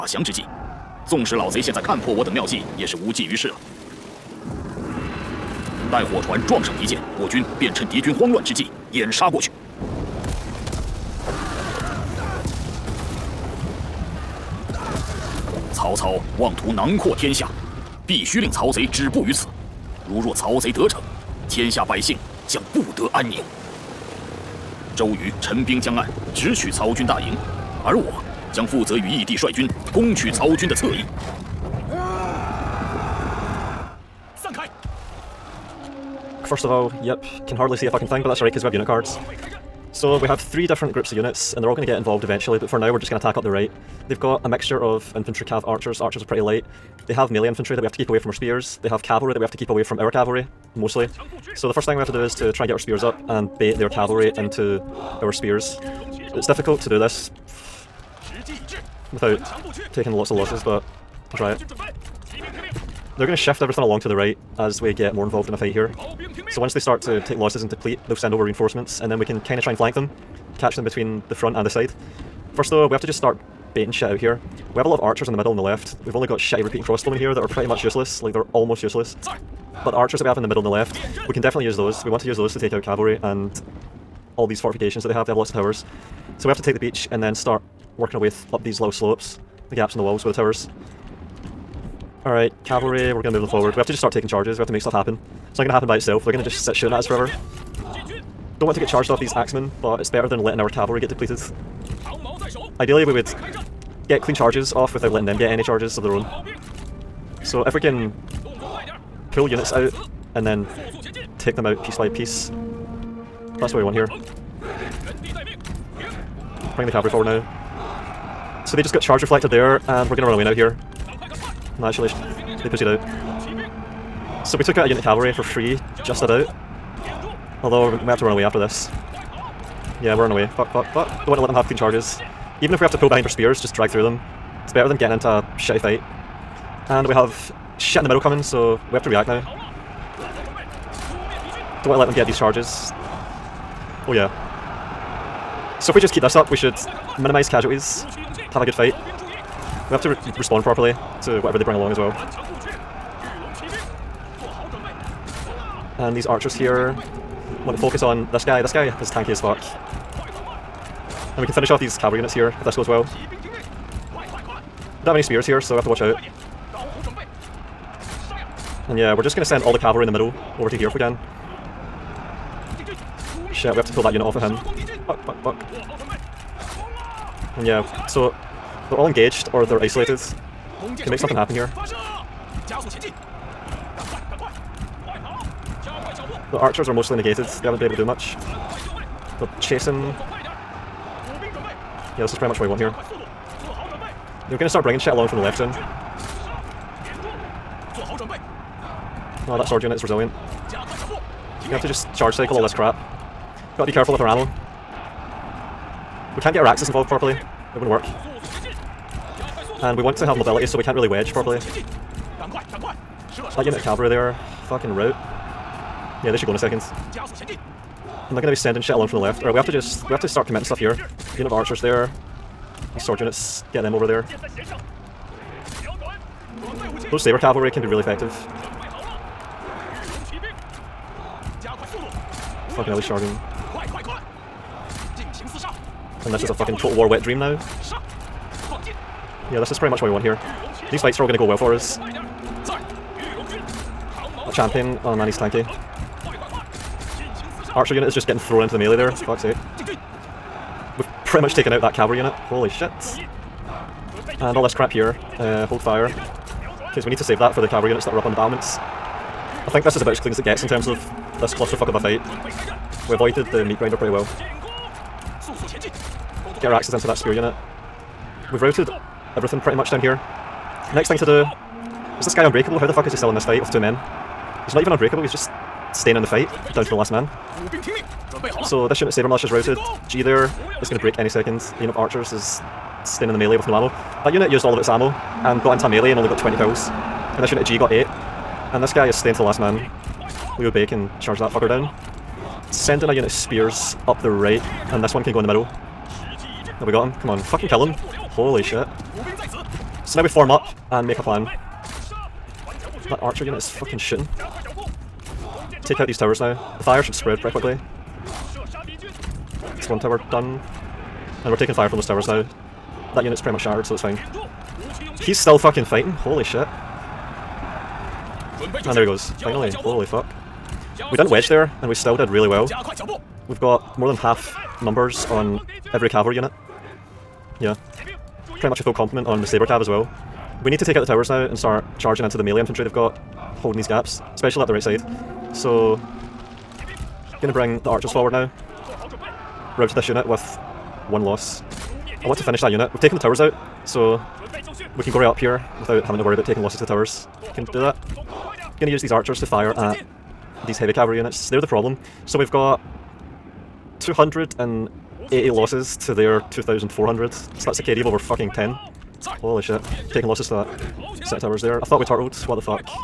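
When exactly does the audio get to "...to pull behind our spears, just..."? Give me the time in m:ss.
2:12.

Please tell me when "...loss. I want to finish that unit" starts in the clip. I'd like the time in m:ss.
5:41.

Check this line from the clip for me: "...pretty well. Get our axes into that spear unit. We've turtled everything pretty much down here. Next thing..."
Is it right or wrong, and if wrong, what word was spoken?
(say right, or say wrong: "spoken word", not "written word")
wrong: "routed", not "turtled".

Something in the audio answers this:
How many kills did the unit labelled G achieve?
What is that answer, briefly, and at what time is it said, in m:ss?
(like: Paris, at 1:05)
8, at 4:47.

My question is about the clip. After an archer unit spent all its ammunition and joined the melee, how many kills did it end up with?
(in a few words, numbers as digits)
20.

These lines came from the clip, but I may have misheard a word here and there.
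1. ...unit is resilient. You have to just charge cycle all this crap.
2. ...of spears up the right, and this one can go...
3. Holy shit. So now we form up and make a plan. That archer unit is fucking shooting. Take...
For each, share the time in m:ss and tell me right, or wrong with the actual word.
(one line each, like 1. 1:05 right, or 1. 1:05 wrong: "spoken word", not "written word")
1. 3:19 right
2. 4:53 right
3. 4:58 right.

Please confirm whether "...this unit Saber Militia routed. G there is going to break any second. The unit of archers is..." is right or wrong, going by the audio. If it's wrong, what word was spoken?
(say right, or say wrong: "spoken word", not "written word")
right.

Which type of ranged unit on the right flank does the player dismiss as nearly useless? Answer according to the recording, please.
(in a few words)
repeating crossbowmen.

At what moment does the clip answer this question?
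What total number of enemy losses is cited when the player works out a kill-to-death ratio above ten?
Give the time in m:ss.
5:56.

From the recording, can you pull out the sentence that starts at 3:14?
They're gonna start bringing shit along from the left soon.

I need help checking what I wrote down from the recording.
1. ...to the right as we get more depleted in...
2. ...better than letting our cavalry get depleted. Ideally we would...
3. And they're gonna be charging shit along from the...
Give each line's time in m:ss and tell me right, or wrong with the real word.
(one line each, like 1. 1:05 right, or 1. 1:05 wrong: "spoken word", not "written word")
1. 1:04 wrong: "involved", not "depleted"
2. 1:40 right
3. 3:38 wrong: "sending", not "charging".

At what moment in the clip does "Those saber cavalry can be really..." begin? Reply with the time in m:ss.
3:47.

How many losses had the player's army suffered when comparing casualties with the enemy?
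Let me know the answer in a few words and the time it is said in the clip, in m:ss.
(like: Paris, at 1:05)
280, at 5:53.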